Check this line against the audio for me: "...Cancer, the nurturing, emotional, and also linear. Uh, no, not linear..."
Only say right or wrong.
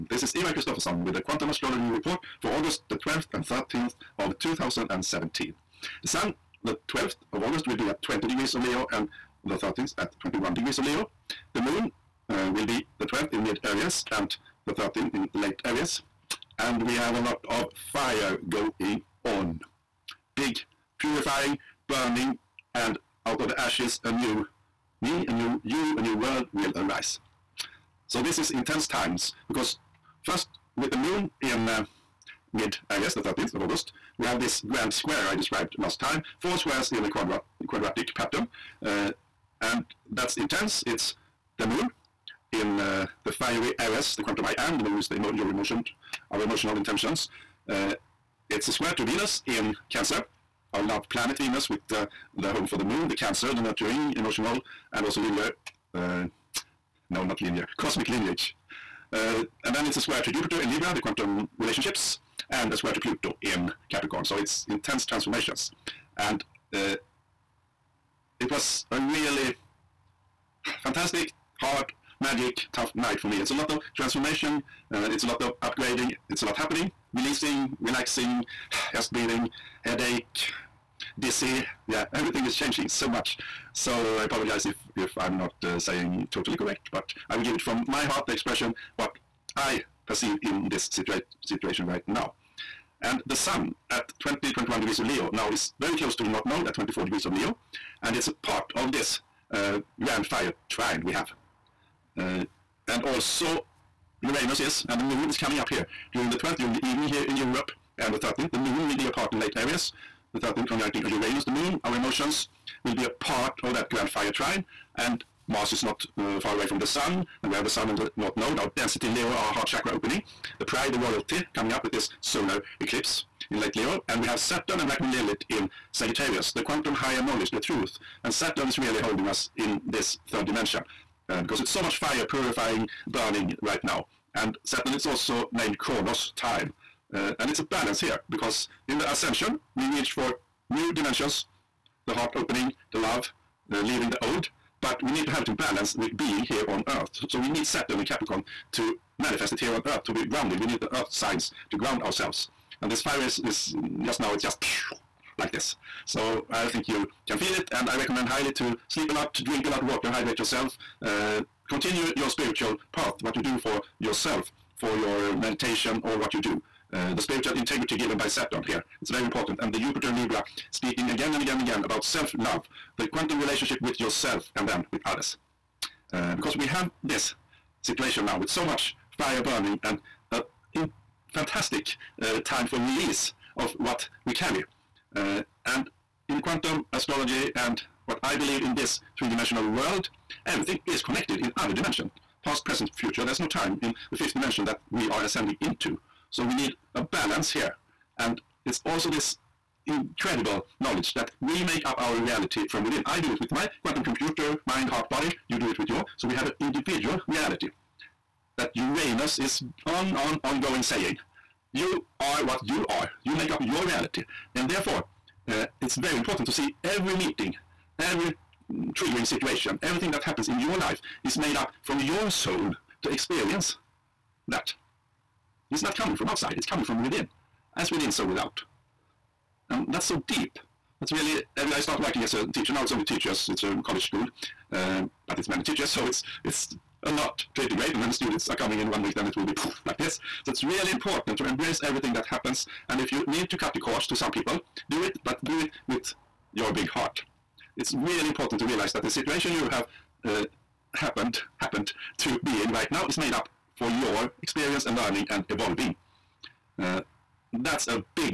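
right.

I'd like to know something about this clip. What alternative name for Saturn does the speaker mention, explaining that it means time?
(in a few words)
Kronos.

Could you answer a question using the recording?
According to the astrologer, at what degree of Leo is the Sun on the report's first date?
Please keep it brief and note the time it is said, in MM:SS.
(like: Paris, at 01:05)
20 degrees, at 00:08.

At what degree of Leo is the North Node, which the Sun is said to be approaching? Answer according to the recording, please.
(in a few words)
24 degrees.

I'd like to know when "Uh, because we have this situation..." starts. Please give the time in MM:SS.
02:56.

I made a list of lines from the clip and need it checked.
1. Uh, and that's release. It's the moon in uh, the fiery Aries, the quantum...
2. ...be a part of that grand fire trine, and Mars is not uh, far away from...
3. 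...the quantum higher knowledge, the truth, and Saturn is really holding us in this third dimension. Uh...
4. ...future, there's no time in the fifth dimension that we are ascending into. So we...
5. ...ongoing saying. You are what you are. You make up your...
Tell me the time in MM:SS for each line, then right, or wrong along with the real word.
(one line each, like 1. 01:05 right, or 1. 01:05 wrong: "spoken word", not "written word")
1. 00:38 wrong: "intense", not "release"
2. 01:52 right
3. 02:06 right
4. 03:12 right
5. 03:30 right.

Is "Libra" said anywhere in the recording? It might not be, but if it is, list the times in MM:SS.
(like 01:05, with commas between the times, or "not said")
01:00, 02:50.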